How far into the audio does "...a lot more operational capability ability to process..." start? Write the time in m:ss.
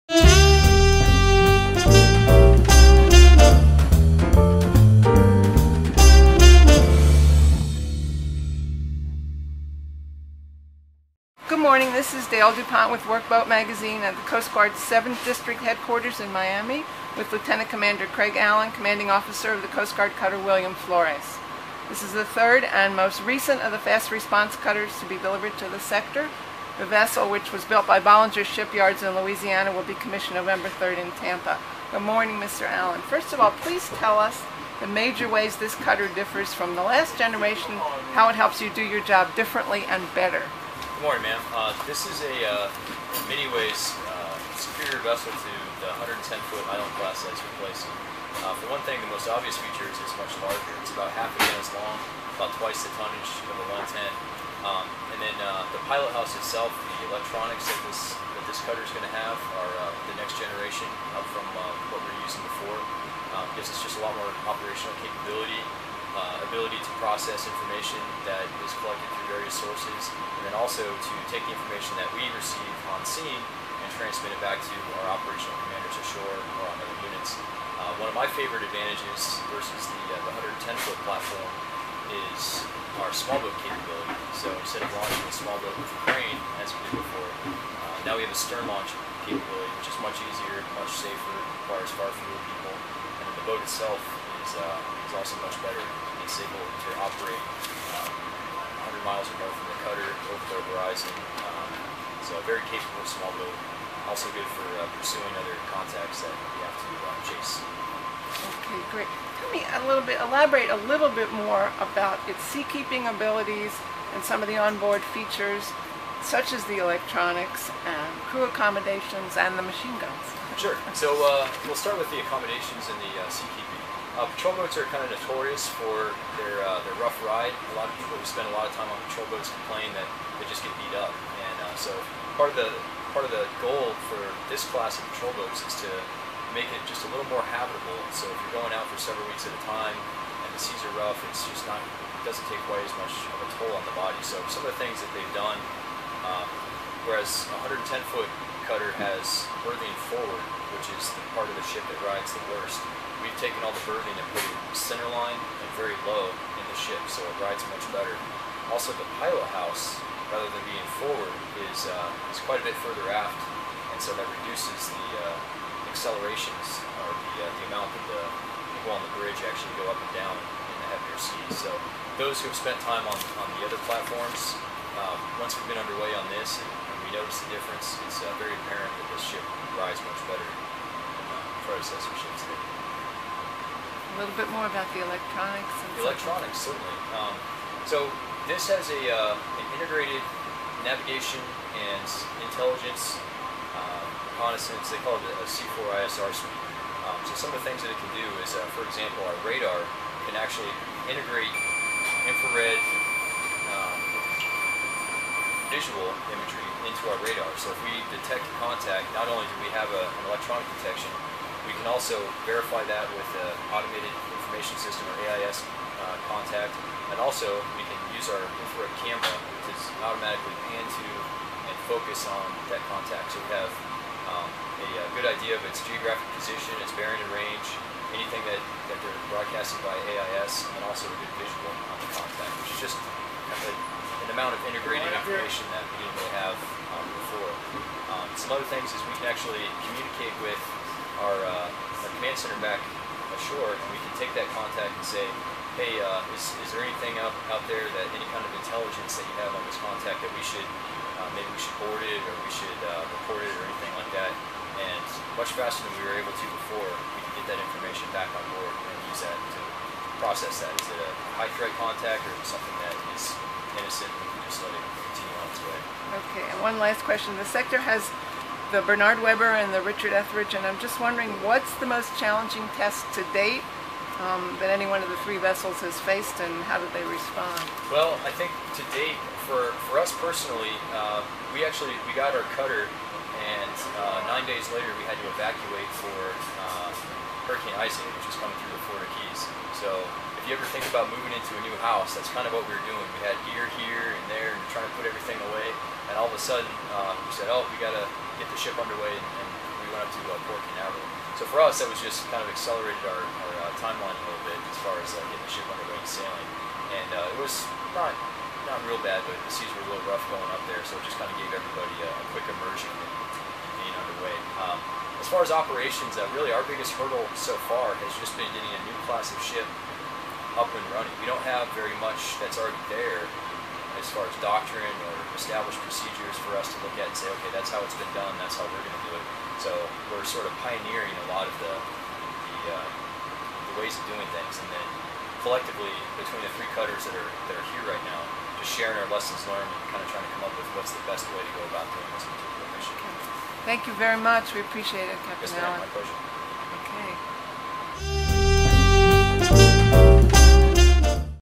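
1:03.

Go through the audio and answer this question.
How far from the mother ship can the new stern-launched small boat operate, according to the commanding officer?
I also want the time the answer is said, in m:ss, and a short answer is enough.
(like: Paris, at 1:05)
100 miles, at 1:38.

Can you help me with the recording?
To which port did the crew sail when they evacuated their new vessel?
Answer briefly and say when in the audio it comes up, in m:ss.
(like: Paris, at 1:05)
Port Canaveral, at 5:00.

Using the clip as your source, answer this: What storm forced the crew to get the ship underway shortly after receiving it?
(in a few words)
Hurricane Isaac.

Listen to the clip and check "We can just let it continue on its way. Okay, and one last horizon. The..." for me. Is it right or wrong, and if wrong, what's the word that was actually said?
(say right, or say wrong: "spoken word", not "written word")
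wrong: "question", not "horizon".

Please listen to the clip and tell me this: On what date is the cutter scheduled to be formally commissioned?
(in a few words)
November 3.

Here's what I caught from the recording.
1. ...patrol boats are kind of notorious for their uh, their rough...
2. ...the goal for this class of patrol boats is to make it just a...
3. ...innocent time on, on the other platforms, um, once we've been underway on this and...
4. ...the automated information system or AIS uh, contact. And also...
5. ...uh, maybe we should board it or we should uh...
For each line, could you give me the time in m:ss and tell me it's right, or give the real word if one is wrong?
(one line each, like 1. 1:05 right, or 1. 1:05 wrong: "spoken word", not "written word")
1. 2:04 right
2. 2:13 right
3. 2:52 wrong: "spent", not "innocent"
4. 3:33 right
5. 4:11 right.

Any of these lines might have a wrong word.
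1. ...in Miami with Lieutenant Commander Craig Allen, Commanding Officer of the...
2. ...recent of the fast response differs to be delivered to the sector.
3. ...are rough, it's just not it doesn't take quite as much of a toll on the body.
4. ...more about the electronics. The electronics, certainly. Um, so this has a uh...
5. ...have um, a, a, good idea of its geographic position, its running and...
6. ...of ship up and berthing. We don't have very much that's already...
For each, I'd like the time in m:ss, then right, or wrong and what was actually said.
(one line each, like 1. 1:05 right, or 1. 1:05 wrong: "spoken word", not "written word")
1. 0:16 right
2. 0:23 wrong: "cutters", not "differs"
3. 2:20 right
4. 3:04 right
5. 3:43 wrong: "bearing", not "running"
6. 5:19 wrong: "running", not "berthing".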